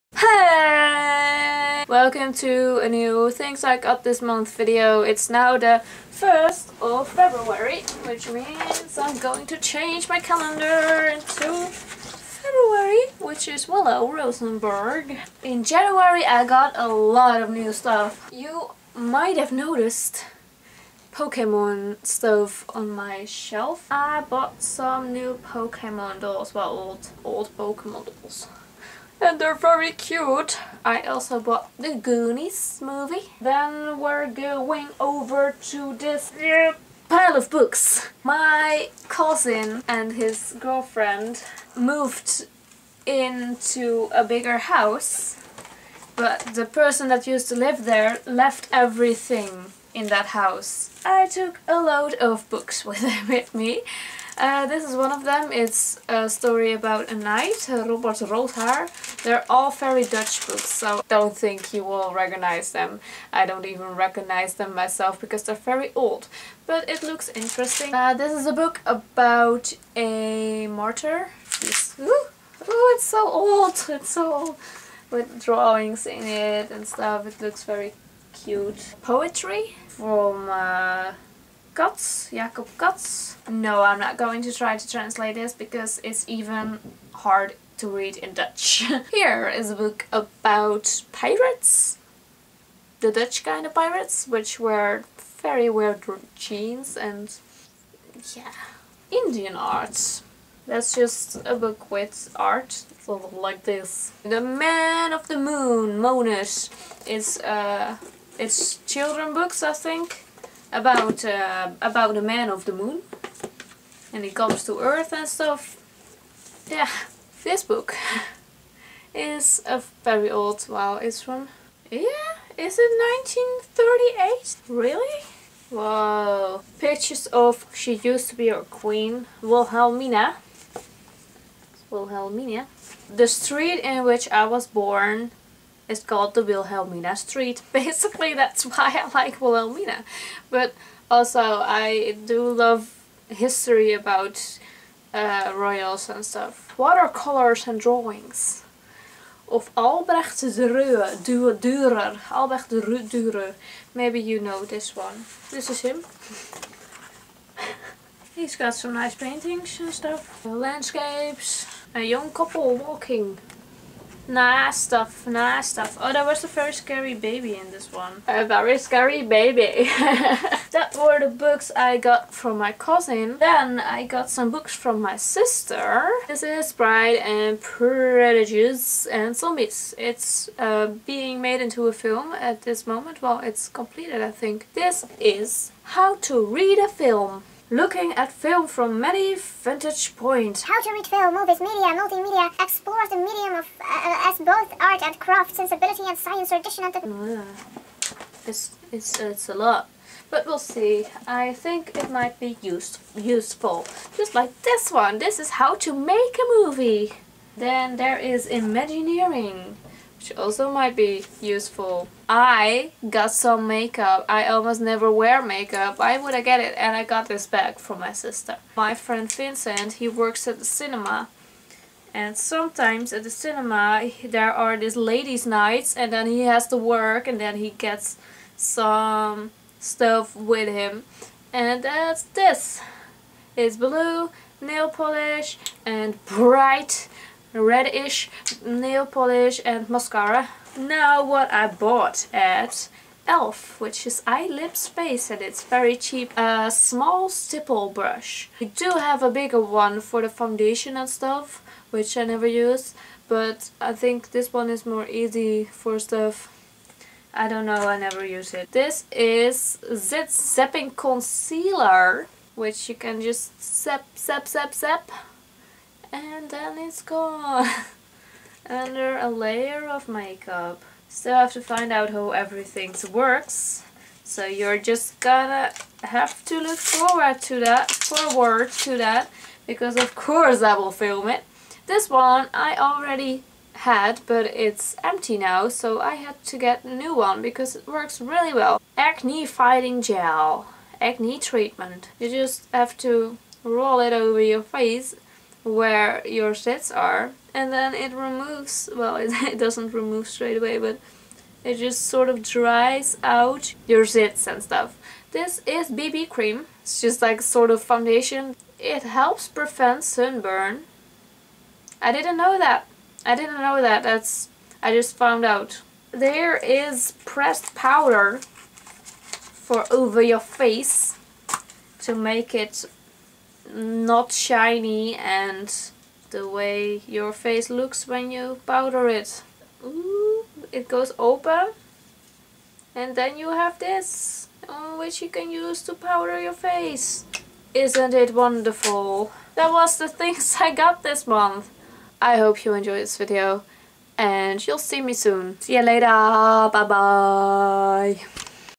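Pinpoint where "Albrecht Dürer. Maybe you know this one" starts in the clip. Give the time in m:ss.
2:32.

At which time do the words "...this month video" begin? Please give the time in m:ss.
0:04.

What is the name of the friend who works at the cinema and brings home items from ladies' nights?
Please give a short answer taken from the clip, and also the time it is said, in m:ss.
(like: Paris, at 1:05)
Vincent, at 3:39.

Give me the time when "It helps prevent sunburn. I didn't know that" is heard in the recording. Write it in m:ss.
5:08.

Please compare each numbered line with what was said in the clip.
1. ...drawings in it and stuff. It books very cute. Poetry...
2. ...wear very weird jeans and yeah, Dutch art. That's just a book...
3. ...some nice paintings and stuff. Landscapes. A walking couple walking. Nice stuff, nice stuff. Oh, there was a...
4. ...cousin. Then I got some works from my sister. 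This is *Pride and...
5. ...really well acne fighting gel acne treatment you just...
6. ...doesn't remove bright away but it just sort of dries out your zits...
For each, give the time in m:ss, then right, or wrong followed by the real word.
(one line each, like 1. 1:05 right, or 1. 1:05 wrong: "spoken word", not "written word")
1. 1:15 wrong: "looks", not "books"
2. 1:34 wrong: "Indian", not "Dutch"
3. 2:38 wrong: "young", not "walking"
4. 2:52 wrong: "books", not "works"
5. 4:48 right
6. 4:59 wrong: "straight", not "bright".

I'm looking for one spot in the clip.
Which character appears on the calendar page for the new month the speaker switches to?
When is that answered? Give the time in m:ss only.
0:13.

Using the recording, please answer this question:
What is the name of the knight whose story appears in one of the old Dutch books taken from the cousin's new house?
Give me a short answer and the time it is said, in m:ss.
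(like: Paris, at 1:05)
Robert Rothaar, at 0:57.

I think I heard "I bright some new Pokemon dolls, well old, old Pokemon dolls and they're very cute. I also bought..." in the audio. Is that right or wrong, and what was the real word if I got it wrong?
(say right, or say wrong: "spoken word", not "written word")
wrong: "bought", not "bright".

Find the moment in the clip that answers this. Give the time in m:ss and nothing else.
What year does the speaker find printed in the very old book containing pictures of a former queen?
2:03.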